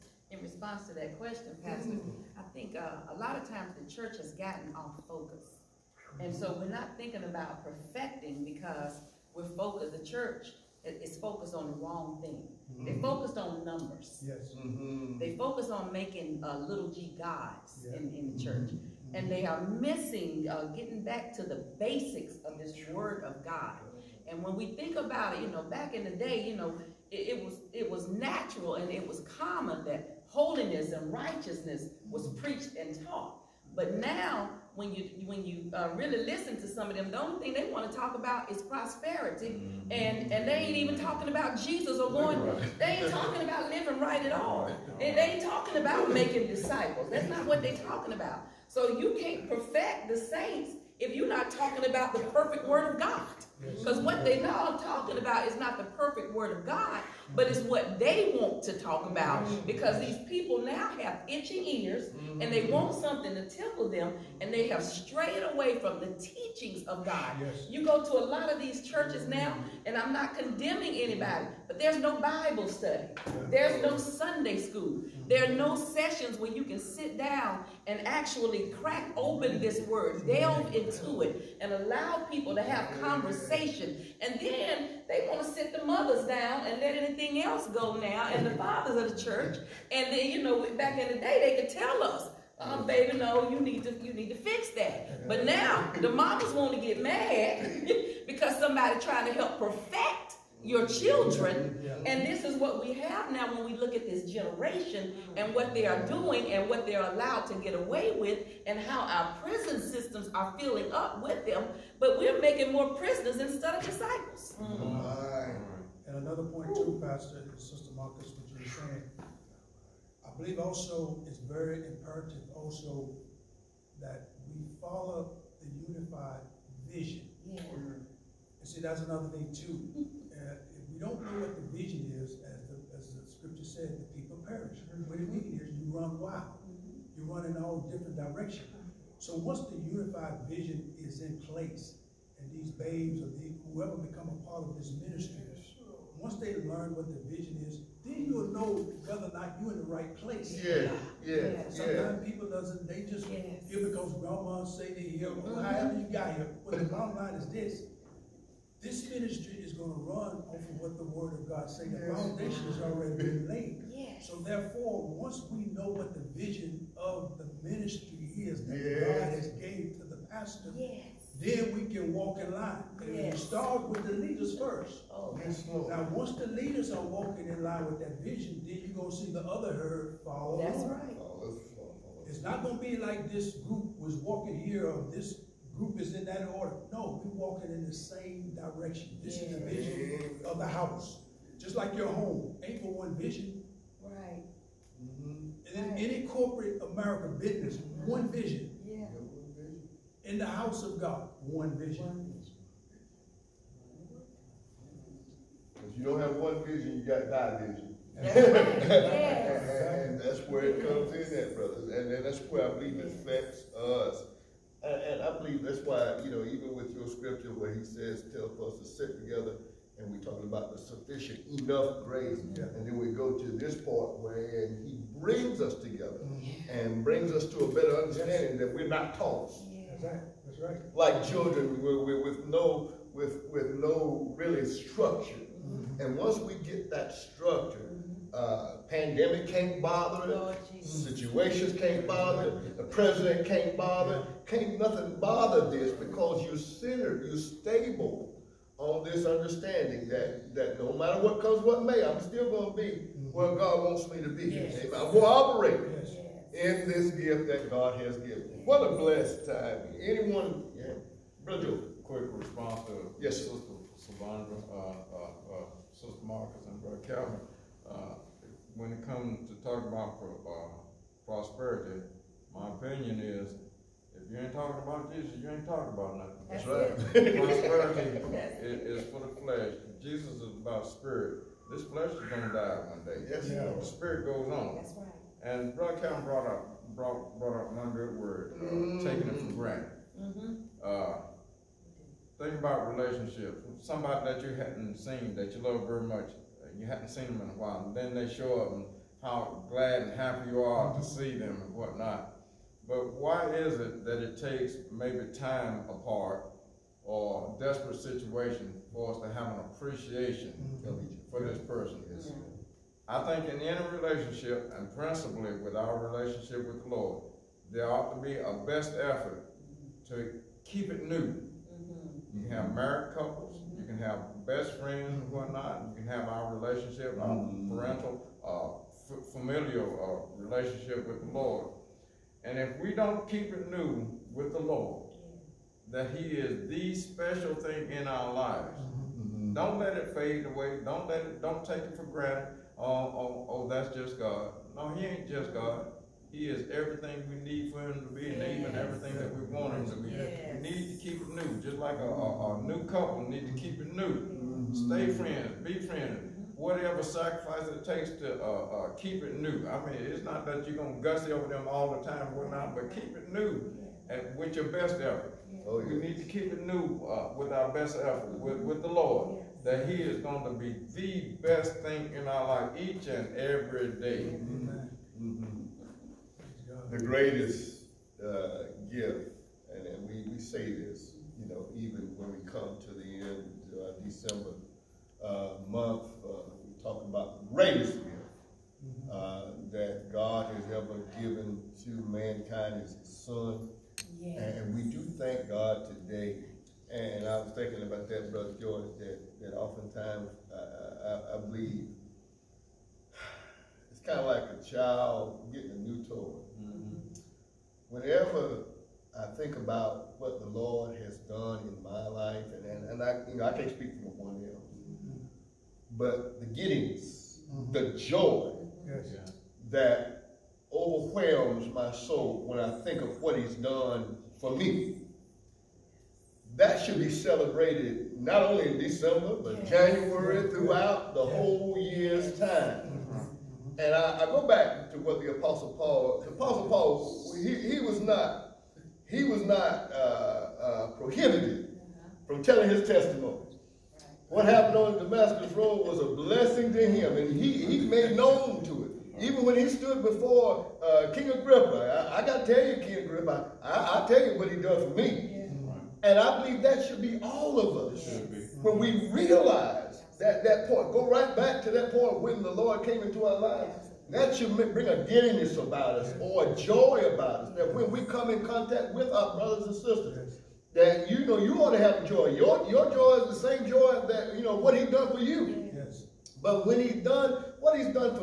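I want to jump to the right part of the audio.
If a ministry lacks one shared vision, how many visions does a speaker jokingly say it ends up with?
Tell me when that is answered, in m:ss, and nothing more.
3:27.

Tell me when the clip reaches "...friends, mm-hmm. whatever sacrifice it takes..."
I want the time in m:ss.
5:55.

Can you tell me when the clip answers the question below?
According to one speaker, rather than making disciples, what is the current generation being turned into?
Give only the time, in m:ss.
1:52.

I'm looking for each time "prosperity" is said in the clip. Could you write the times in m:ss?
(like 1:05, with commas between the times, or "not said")
0:38, 4:31, 4:37.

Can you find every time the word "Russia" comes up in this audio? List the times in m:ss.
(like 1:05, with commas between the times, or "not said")
not said.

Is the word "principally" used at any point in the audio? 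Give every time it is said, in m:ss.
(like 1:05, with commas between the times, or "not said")
5:14.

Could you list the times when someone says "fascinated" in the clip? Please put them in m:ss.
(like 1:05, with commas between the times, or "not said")
not said.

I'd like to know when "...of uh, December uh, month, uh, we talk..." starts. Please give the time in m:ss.
6:23.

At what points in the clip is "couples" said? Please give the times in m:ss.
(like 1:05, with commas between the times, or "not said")
5:23, 5:52.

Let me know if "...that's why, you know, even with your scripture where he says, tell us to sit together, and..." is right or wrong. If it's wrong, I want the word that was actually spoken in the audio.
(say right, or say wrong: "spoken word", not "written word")
right.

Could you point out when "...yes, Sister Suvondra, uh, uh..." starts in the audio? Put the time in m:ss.
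4:23.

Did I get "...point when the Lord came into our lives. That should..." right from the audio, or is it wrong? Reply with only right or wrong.
right.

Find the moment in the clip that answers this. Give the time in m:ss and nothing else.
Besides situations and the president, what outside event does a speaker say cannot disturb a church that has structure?
3:58.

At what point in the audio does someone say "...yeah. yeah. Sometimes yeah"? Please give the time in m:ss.
2:31.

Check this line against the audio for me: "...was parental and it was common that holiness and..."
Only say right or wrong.
wrong.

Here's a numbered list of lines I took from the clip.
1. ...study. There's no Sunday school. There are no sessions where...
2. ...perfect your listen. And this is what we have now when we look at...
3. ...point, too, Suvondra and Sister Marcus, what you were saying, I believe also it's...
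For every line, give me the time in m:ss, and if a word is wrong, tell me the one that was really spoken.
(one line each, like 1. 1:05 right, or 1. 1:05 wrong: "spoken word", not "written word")
1. 1:12 right
2. 1:39 wrong: "children", not "listen"
3. 1:56 wrong: "Pastor", not "Suvondra".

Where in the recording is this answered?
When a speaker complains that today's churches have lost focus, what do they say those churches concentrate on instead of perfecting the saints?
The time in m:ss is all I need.
0:13.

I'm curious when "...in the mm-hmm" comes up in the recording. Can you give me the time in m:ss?
0:18.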